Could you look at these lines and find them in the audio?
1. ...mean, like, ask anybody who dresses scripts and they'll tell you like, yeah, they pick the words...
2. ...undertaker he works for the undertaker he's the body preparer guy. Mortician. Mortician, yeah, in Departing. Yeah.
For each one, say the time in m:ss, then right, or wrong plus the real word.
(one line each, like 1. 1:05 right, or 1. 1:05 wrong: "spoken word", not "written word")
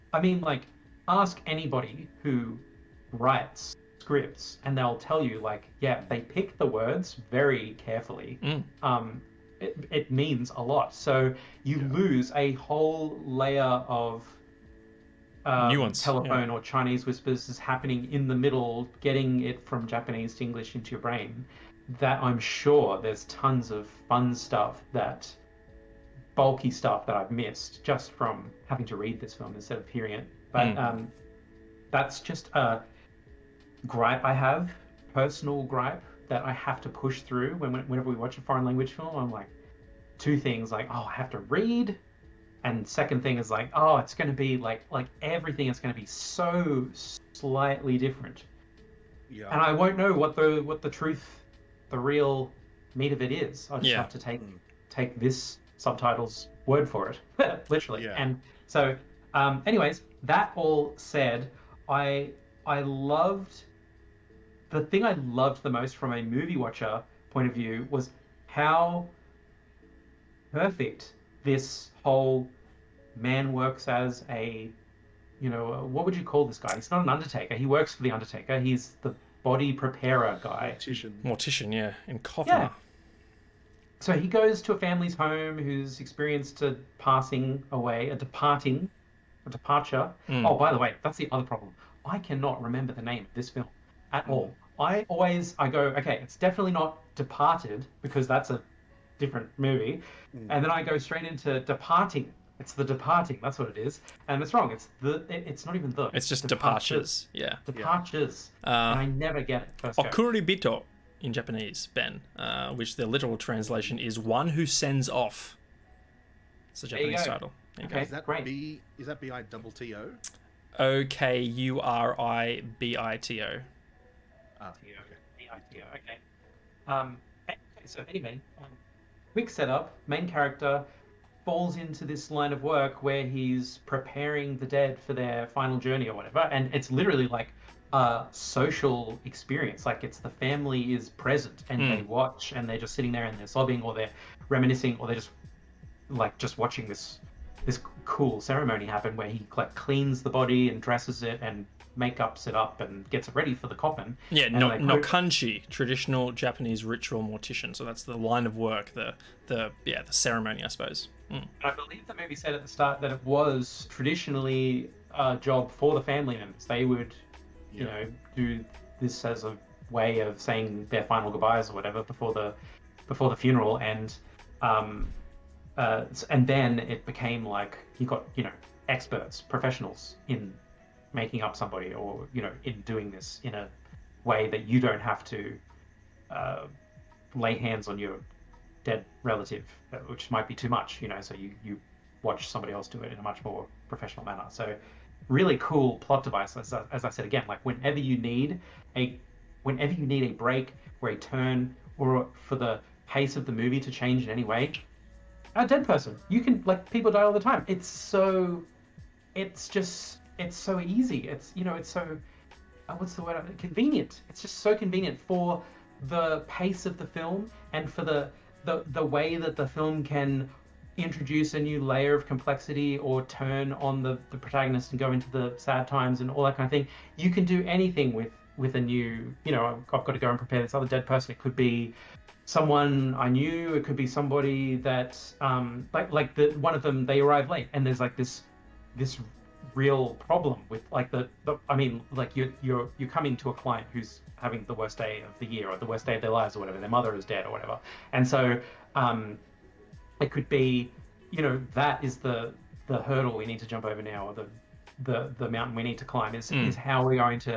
1. 0:00 wrong: "writes", not "dresses"
2. 1:17 wrong: "Coffin", not "Departing".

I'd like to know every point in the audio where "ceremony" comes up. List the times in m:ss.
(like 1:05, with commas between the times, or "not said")
2:28, 2:40.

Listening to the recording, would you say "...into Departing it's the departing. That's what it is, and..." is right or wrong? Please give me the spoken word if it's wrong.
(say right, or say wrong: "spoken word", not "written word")
right.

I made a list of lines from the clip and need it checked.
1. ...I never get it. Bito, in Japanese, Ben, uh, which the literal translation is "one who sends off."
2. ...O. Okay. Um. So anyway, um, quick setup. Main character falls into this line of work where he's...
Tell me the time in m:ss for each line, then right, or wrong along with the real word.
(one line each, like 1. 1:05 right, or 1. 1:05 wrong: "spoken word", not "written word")
1. 1:48 right
2. 2:05 right.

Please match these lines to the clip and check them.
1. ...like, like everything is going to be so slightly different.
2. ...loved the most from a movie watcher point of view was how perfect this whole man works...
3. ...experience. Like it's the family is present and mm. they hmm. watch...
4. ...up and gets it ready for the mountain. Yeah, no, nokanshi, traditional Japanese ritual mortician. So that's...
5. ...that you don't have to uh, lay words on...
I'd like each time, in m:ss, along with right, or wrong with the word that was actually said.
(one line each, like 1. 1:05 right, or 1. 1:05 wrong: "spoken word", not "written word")
1. 0:44 right
2. 1:05 right
3. 2:19 right
4. 2:32 wrong: "coffin", not "mountain"
5. 3:04 wrong: "hands", not "words".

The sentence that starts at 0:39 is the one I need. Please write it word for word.
I'm like, two things like, oh, I have to read.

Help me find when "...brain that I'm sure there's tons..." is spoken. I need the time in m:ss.
0:21.